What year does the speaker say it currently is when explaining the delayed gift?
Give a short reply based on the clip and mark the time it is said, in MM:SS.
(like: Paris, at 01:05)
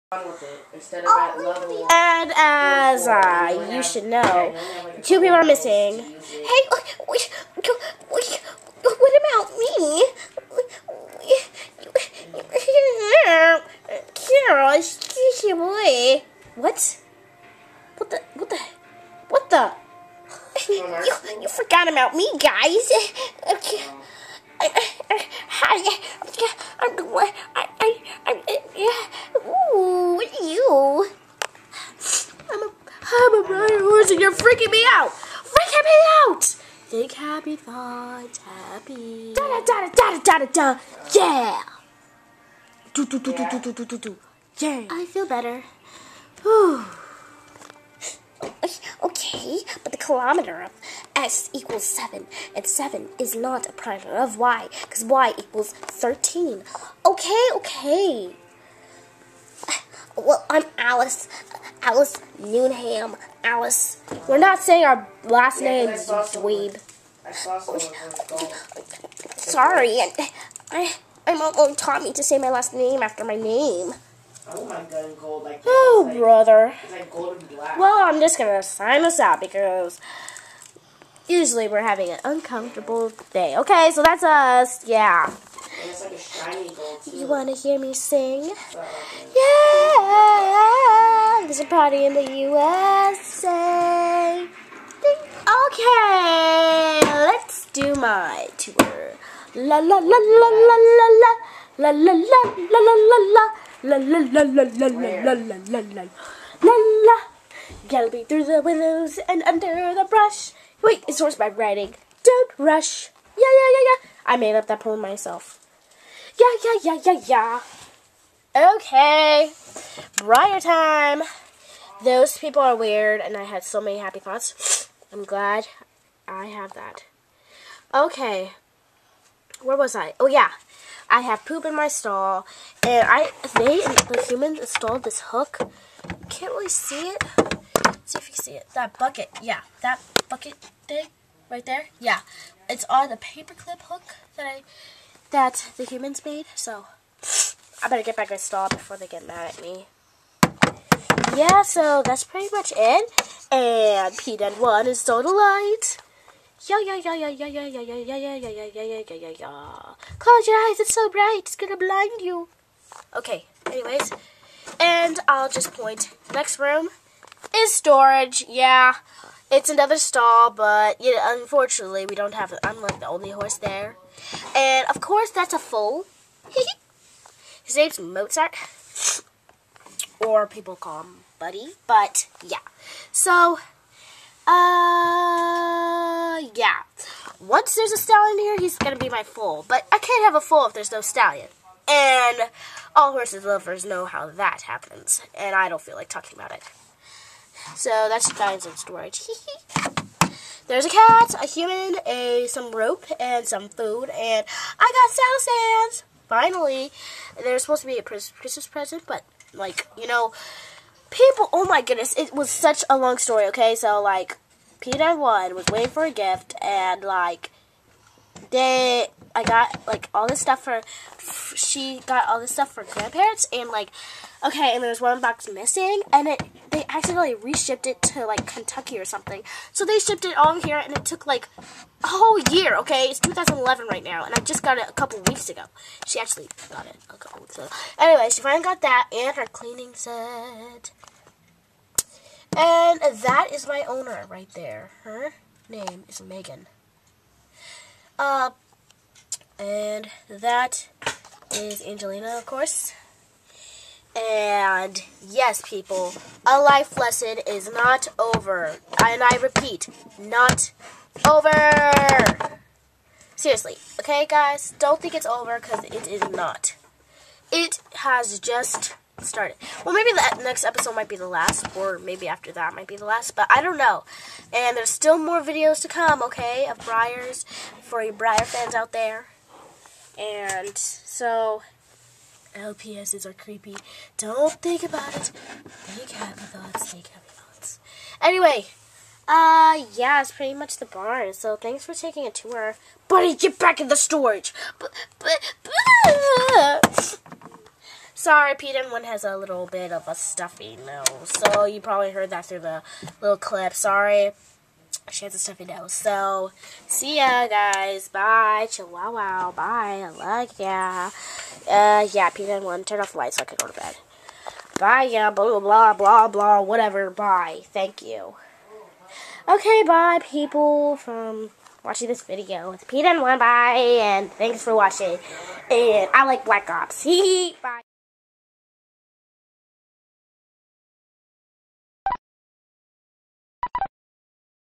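2011, at 03:53.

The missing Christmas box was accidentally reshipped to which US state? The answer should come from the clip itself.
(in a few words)
Kentucky.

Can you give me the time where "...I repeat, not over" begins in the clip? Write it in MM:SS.
04:19.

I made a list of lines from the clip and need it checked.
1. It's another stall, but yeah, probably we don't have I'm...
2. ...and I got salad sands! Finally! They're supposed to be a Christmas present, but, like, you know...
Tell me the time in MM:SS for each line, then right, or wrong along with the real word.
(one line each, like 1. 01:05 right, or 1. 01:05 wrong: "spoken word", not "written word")
1. 02:49 wrong: "unfortunately", not "probably"
2. 03:24 right.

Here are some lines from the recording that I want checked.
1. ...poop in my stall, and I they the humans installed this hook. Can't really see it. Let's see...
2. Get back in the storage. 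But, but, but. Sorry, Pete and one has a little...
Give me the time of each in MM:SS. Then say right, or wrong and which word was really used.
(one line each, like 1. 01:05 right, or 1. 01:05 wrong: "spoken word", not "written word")
1. 02:11 right
2. 04:53 right.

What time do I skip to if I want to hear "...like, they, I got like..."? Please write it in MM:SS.
03:37.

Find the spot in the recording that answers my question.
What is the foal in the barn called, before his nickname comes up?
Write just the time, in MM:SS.
02:57.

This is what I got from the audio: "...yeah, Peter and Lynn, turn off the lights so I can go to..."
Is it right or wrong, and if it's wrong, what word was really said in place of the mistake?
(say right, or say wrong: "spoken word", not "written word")
right.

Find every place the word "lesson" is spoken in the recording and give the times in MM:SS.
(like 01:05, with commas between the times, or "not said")
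04:16.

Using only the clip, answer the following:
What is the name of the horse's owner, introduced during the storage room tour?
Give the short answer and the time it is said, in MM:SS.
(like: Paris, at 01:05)
Megan, at 04:06.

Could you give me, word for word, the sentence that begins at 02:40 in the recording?
Close your eyes, it's so bright, it's gonna blind you.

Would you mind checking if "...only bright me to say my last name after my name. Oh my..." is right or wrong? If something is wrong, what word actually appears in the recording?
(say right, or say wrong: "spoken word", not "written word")
wrong: "taught", not "bright".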